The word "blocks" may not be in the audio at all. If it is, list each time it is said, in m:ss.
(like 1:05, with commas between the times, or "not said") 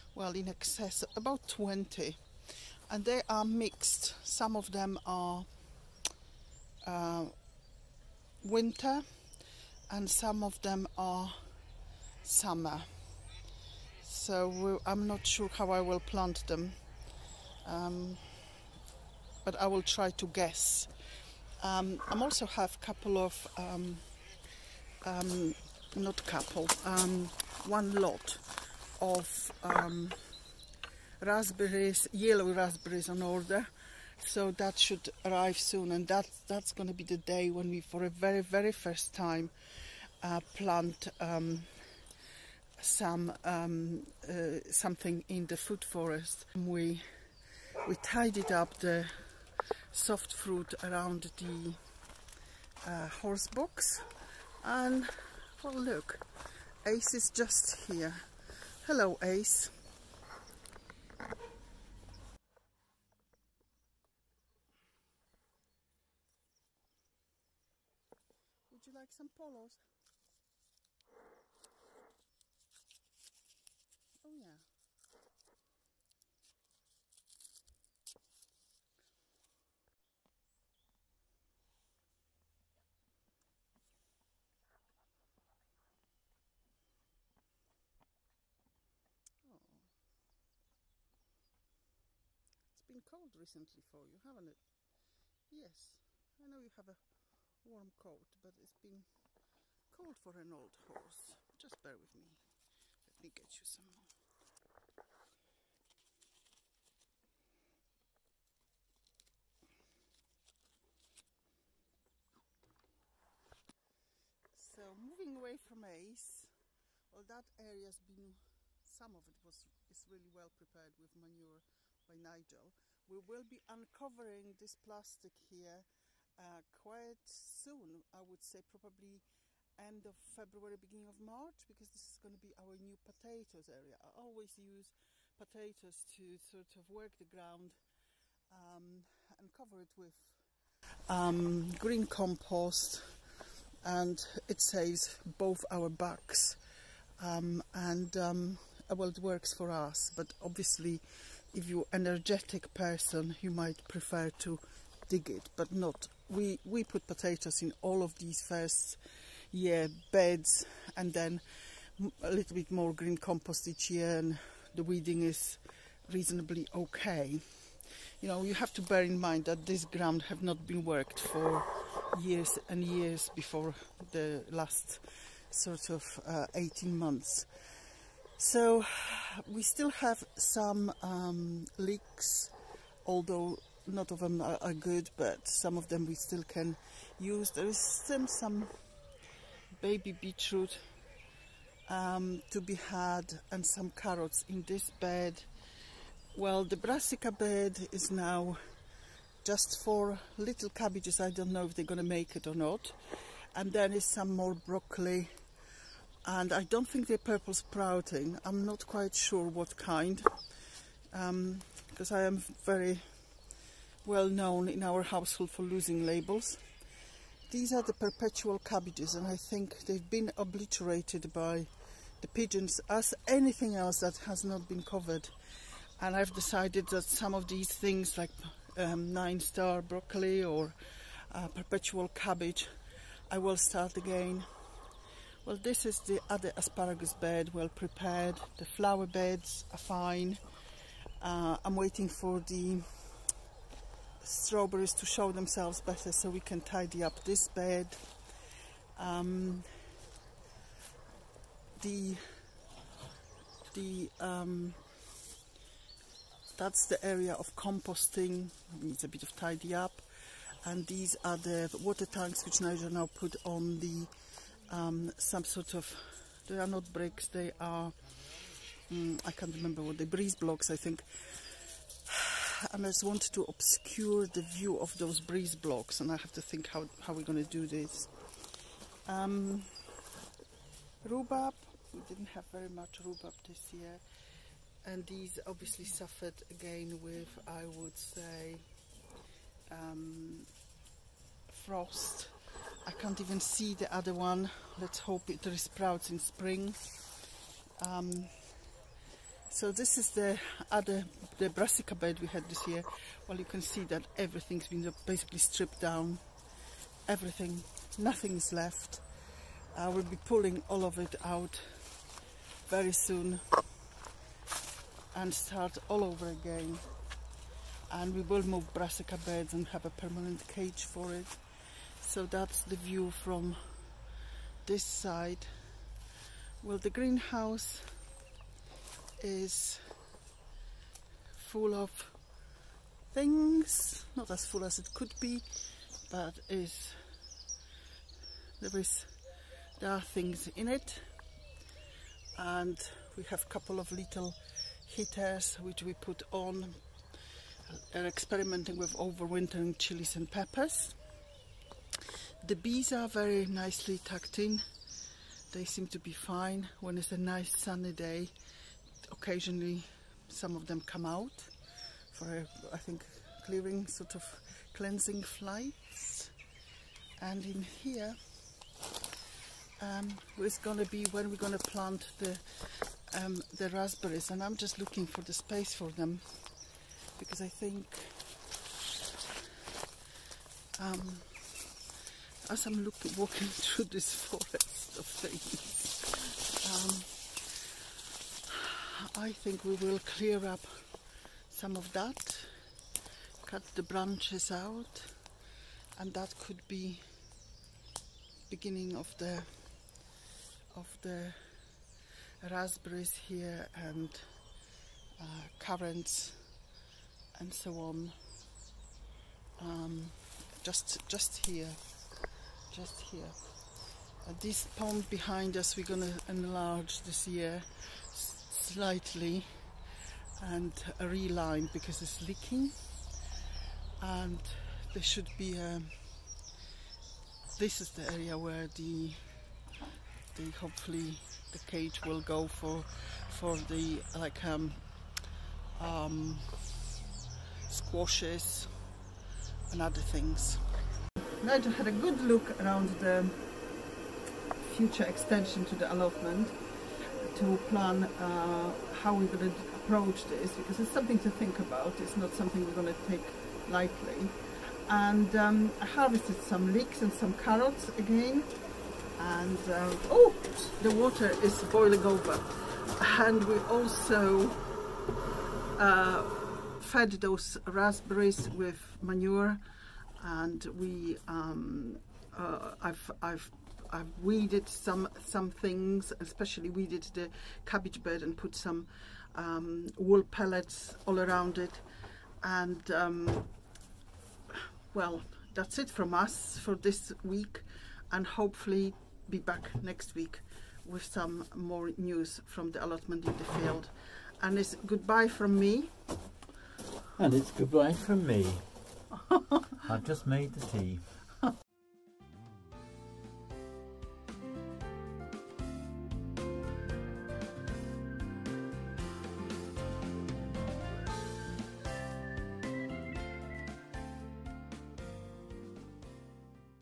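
4:30, 4:35.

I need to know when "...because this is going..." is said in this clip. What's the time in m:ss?
2:11.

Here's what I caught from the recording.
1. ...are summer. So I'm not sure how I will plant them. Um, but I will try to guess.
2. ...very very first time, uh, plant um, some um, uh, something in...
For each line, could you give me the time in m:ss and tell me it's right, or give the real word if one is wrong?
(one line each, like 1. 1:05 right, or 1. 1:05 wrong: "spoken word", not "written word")
1. 0:10 right
2. 0:38 right.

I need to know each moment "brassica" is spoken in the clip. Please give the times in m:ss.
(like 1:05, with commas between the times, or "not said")
3:16, 5:01, 5:18.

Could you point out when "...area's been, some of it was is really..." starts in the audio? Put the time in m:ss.
1:57.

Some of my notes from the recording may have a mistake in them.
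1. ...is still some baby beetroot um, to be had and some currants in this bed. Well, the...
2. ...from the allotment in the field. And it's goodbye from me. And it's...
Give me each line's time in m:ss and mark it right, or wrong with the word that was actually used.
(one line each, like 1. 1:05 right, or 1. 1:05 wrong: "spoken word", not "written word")
1. 3:07 wrong: "carrots", not "currants"
2. 8:12 right.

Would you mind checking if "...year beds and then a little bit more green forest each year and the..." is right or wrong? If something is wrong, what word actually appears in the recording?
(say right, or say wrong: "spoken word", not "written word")
wrong: "compost", not "forest".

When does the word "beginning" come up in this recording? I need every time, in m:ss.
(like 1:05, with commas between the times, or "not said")
2:10, 6:38.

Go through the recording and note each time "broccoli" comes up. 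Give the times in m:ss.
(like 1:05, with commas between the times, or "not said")
3:24, 3:49.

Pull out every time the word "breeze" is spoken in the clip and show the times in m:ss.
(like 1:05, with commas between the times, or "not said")
4:30, 4:35.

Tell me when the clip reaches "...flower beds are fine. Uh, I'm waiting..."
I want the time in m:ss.
3:58.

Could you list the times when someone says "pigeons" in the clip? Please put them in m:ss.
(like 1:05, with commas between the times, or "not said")
3:42.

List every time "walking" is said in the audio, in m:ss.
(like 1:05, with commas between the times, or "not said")
6:23.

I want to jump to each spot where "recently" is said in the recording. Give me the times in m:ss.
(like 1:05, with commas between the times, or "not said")
1:33.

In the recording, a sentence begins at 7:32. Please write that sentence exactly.
It's not something we're going to take lightly.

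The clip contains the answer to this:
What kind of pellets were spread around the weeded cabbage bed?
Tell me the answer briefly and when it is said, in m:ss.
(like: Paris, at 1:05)
Wool pellets, at 7:59.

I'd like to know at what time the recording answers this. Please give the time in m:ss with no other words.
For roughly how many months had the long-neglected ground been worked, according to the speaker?
2:56.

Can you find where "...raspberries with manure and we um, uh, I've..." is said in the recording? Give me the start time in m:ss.
7:47.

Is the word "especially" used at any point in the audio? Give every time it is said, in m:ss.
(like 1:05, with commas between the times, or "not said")
7:56.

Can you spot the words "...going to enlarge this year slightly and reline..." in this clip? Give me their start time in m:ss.
6:55.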